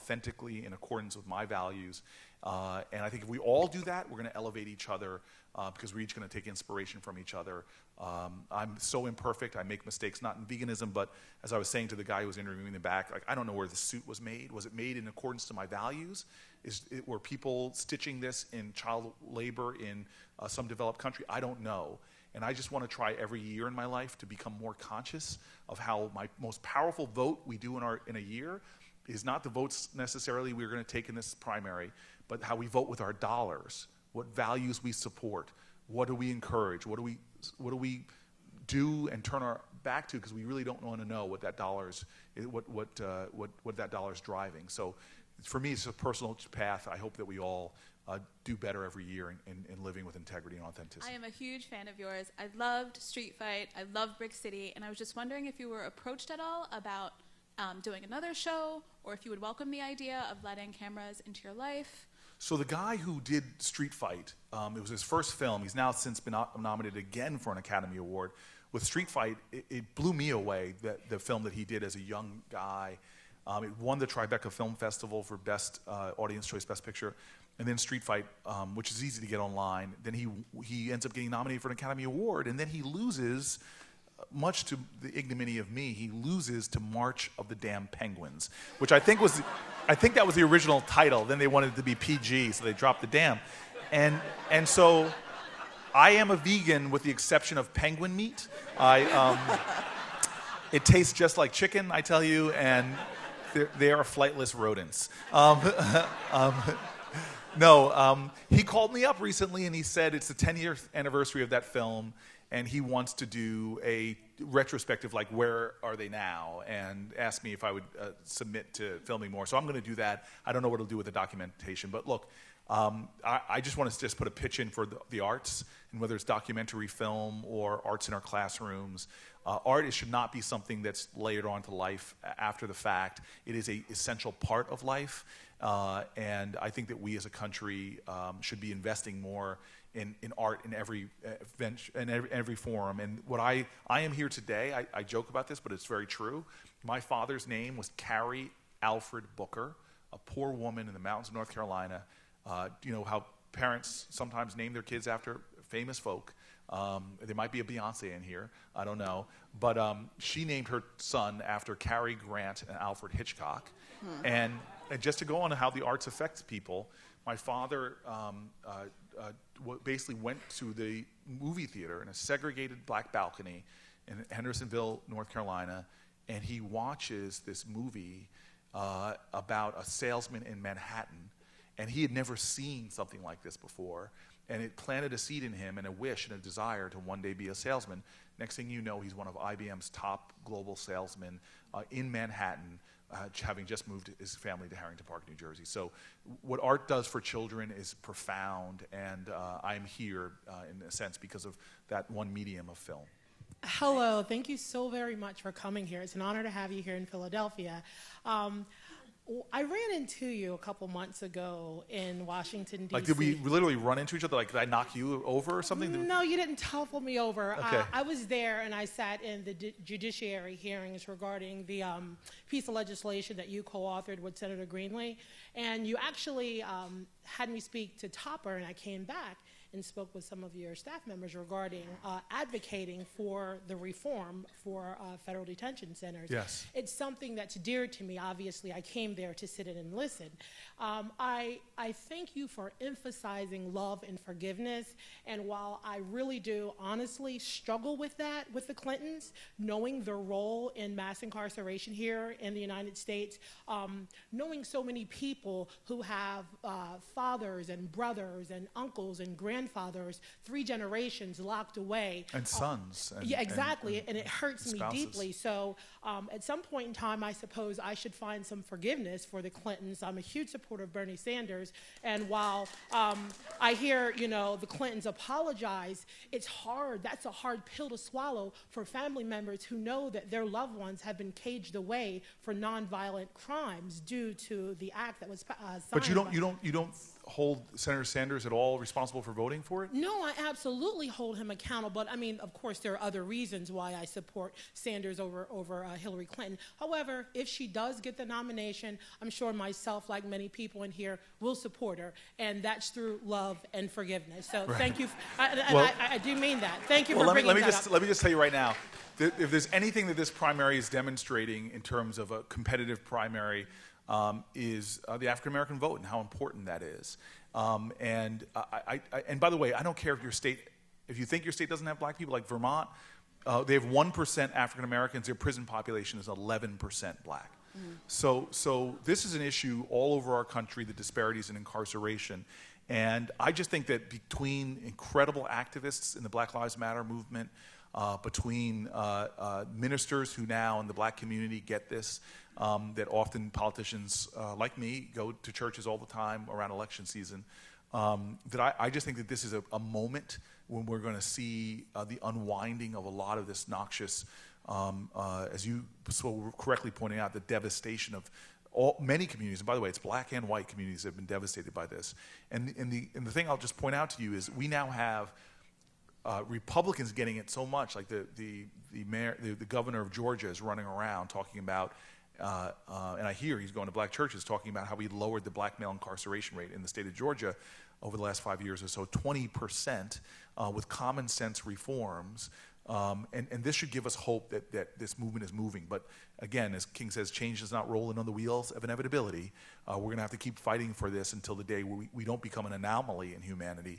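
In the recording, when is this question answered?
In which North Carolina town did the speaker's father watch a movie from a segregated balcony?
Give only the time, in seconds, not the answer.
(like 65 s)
174 s.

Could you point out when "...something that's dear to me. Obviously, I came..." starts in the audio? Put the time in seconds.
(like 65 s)
236 s.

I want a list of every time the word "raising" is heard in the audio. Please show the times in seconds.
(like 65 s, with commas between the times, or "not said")
not said.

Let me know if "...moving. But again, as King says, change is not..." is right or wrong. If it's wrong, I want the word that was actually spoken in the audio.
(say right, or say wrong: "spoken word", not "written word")
right.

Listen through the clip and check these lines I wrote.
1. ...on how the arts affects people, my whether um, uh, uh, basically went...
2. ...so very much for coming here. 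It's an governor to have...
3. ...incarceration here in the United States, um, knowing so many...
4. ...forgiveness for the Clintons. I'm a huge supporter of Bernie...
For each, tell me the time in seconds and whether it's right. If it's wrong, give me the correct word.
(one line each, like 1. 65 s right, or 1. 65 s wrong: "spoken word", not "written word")
1. 165 s wrong: "father", not "whether"
2. 204 s wrong: "honor", not "governor"
3. 251 s right
4. 268 s right.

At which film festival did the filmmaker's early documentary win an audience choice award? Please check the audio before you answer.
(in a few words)
Tribeca Film Festival.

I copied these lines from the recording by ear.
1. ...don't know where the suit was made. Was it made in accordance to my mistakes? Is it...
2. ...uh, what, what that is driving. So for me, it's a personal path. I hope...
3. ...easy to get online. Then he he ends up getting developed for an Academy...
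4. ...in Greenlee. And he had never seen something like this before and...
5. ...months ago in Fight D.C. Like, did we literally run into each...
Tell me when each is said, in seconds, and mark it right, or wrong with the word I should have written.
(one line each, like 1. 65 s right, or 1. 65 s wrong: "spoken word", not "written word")
1. 13 s wrong: "values", not "mistakes"
2. 42 s right
3. 79 s wrong: "nominated", not "developed"
4. 180 s wrong: "Manhattan", not "Greenlee"
5. 210 s wrong: "Washington", not "Fight".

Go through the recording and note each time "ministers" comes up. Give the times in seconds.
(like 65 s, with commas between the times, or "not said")
339 s.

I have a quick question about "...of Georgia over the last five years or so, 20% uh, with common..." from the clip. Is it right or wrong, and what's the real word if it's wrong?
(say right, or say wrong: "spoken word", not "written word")
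right.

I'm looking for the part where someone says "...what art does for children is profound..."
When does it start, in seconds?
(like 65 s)
196 s.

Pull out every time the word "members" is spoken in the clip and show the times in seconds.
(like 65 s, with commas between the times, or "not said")
231 s, 279 s.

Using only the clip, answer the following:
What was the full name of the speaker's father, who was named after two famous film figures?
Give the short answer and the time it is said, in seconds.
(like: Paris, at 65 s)
Cary Alfred Booker, at 147 s.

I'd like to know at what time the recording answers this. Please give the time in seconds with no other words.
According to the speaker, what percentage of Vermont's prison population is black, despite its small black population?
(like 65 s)
326 s.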